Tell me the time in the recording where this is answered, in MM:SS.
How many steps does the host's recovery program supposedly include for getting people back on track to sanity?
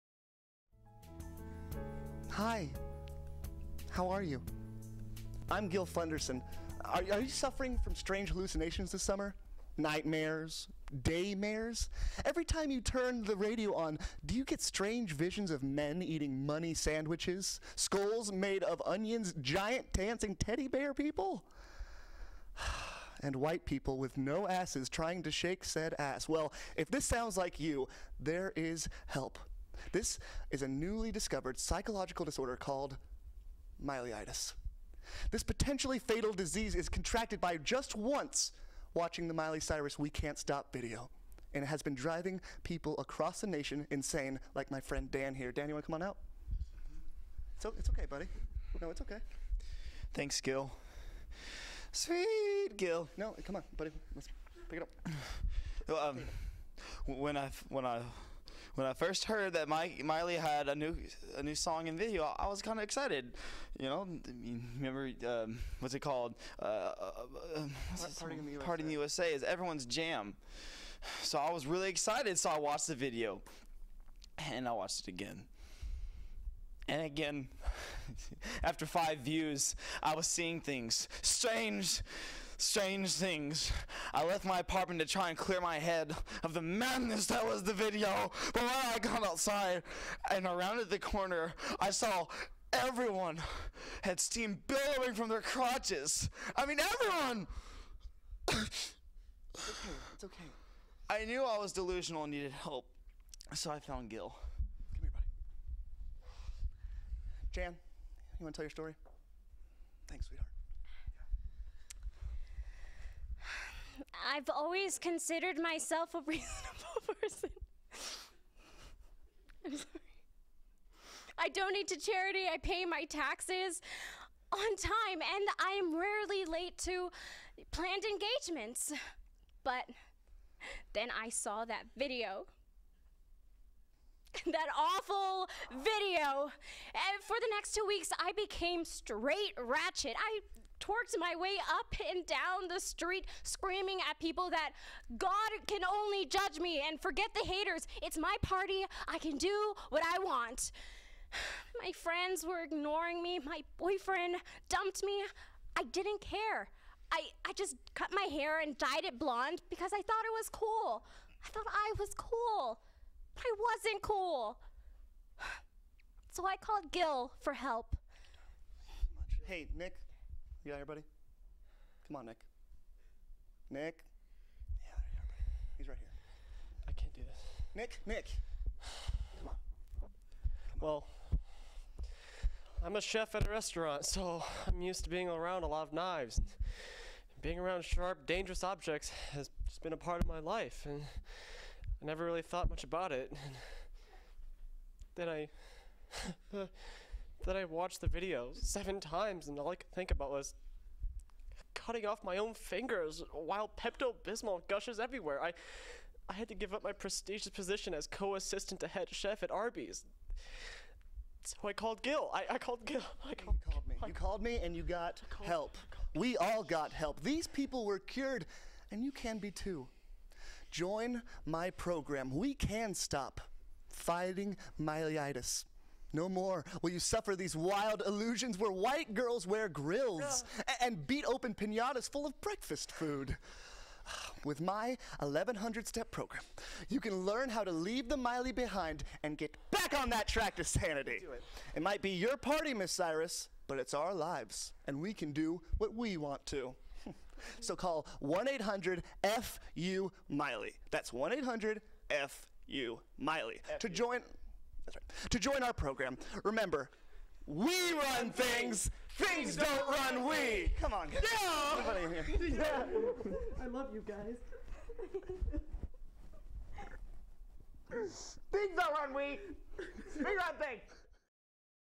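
03:55.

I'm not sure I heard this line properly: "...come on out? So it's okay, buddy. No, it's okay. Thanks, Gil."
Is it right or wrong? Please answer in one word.
right.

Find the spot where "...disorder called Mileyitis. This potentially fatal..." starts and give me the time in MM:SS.
00:32.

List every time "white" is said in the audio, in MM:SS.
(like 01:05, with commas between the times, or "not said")
00:23, 03:48.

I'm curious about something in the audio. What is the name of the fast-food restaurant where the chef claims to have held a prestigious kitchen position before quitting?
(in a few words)
Arby's.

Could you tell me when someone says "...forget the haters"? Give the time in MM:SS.
02:26.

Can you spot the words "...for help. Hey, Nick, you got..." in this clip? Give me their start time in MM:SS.
02:47.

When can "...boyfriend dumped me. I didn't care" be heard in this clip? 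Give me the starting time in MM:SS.
02:33.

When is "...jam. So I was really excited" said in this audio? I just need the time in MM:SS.
01:09.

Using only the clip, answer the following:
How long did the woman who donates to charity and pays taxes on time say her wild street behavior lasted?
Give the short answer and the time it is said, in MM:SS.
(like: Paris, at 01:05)
two weeks, at 02:17.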